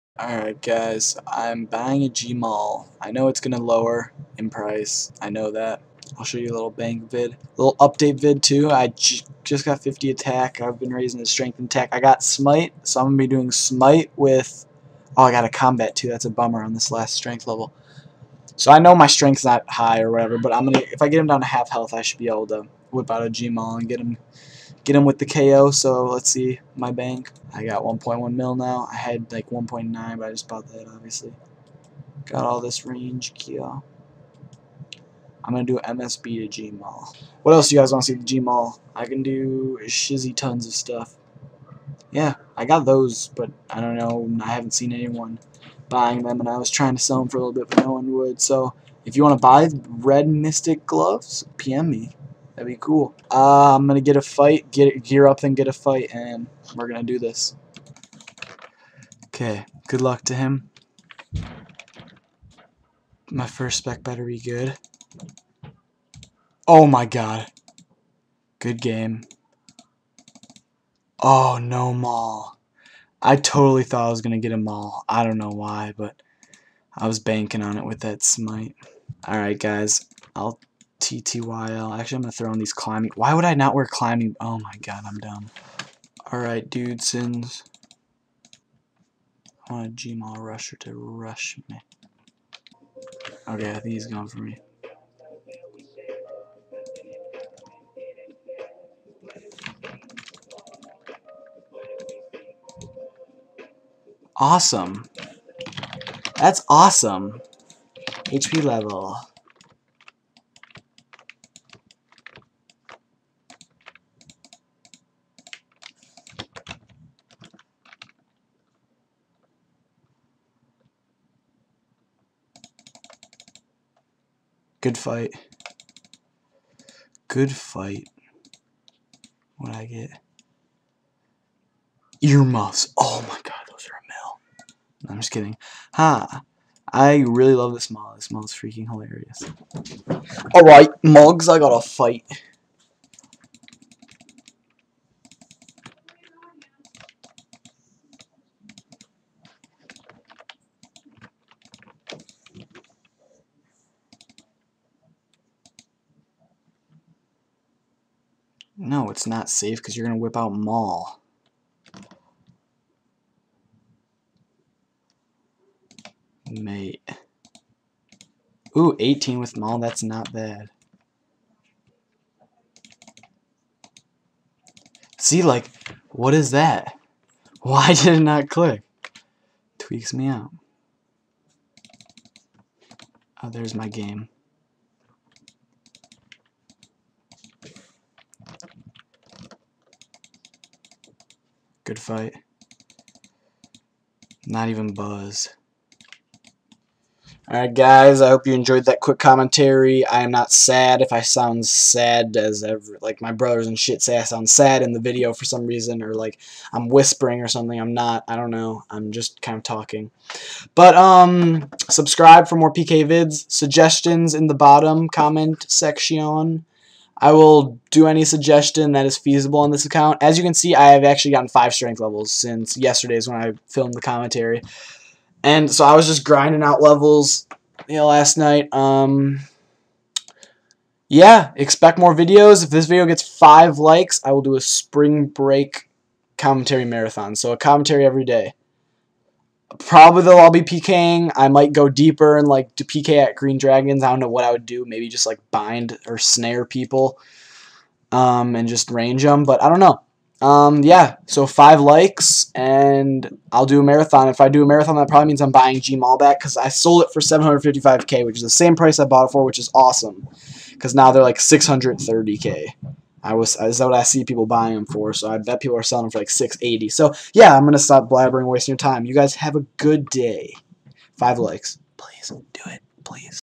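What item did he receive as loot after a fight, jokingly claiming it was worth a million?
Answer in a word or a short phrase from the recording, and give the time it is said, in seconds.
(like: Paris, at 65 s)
Earmuffs, at 132 s.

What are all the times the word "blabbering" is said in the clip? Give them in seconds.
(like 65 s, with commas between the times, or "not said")
268 s.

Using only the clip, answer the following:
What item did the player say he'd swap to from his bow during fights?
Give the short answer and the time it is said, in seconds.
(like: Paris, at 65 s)
MSB, at 35 s.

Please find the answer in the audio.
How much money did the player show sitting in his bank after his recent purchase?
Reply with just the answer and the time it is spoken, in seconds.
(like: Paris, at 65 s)
1.1 mil, at 27 s.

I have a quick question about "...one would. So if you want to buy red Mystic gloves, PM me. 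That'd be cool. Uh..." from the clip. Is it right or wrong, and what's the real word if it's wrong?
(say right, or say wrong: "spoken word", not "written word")
right.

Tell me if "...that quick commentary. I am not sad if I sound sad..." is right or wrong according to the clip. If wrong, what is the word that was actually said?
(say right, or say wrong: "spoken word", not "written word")
right.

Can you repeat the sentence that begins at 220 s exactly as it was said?
As you can see, I have actually gotten five strength levels since yesterday's when I filmed the commentary.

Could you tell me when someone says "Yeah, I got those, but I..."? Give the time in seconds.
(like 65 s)
42 s.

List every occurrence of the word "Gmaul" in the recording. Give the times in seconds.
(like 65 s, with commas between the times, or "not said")
2 s, 23 s, 89 s, 255 s.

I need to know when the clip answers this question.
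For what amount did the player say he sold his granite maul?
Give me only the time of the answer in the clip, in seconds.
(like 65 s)
257 s.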